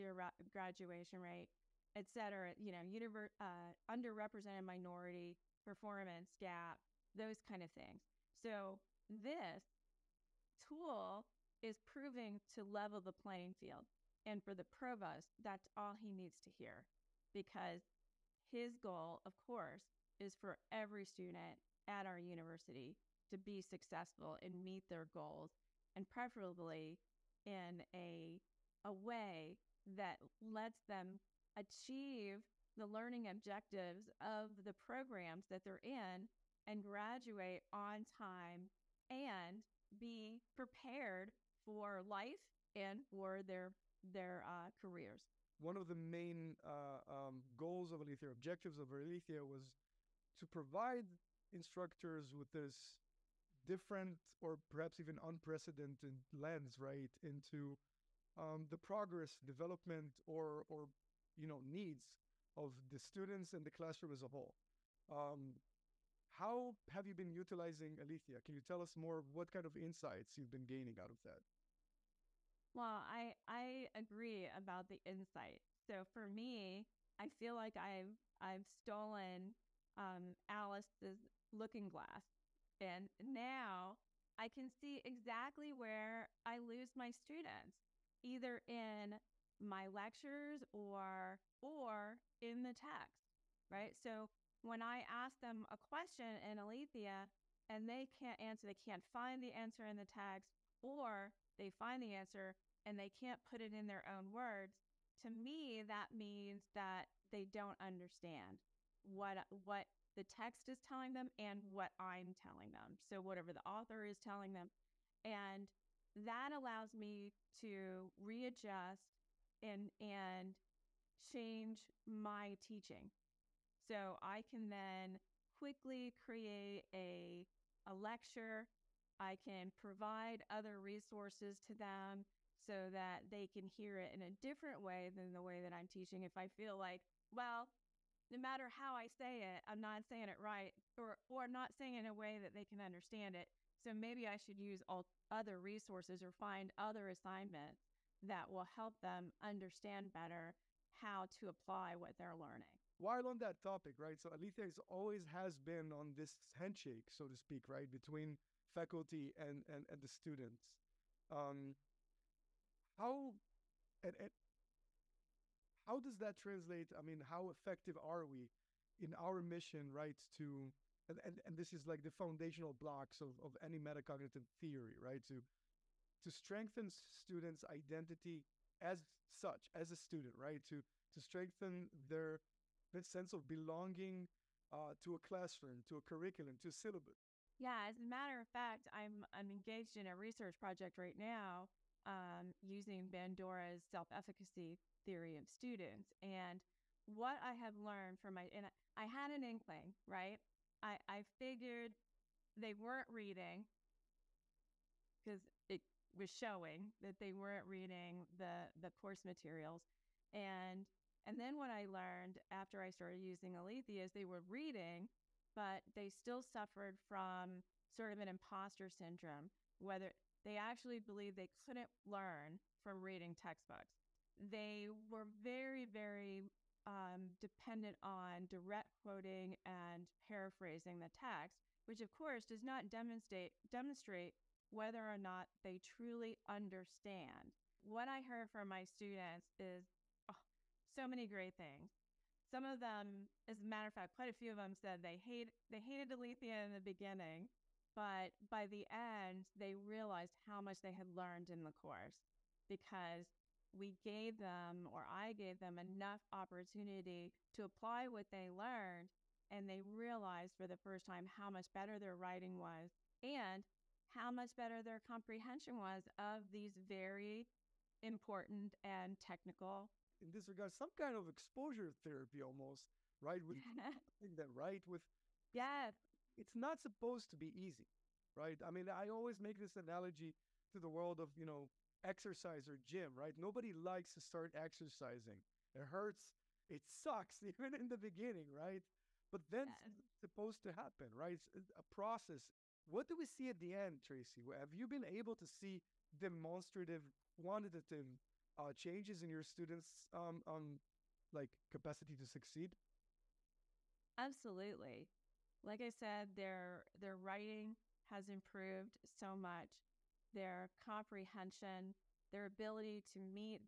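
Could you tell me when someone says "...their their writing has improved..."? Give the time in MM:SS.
05:06.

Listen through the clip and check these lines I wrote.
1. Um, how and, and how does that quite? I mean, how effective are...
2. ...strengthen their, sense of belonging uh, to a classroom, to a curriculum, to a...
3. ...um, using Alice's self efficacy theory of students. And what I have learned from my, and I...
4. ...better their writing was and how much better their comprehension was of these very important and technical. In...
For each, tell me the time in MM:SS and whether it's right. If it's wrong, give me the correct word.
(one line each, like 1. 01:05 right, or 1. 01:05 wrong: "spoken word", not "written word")
1. 02:41 wrong: "translate", not "quite"
2. 03:01 right
3. 03:12 wrong: "Bandura", not "Alice"
4. 04:21 right.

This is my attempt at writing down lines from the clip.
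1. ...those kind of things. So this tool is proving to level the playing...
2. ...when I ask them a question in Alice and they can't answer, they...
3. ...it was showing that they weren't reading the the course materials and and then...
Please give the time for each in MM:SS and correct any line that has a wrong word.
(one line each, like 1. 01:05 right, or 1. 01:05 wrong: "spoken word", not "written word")
1. 00:07 right
2. 01:34 wrong: "Alethea", not "Alice"
3. 03:25 right.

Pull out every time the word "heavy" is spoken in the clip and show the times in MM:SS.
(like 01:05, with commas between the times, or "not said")
not said.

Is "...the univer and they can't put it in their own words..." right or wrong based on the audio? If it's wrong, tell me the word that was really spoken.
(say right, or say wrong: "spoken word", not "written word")
wrong: "answer", not "univer".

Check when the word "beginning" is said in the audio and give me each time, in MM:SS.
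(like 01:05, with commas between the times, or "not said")
04:06, 04:47.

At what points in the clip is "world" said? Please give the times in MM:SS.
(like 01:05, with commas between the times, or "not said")
04:40.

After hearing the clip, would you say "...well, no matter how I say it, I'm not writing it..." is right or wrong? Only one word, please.
wrong.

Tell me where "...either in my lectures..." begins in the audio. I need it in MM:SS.
01:28.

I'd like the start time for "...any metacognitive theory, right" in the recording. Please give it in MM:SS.
02:53.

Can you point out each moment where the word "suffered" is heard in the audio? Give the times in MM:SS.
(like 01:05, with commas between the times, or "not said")
03:36.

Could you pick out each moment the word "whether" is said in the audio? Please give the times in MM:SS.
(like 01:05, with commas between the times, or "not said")
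03:39, 03:54.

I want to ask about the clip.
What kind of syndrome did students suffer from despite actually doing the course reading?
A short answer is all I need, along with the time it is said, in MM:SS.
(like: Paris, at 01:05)
imposter syndrome, at 03:38.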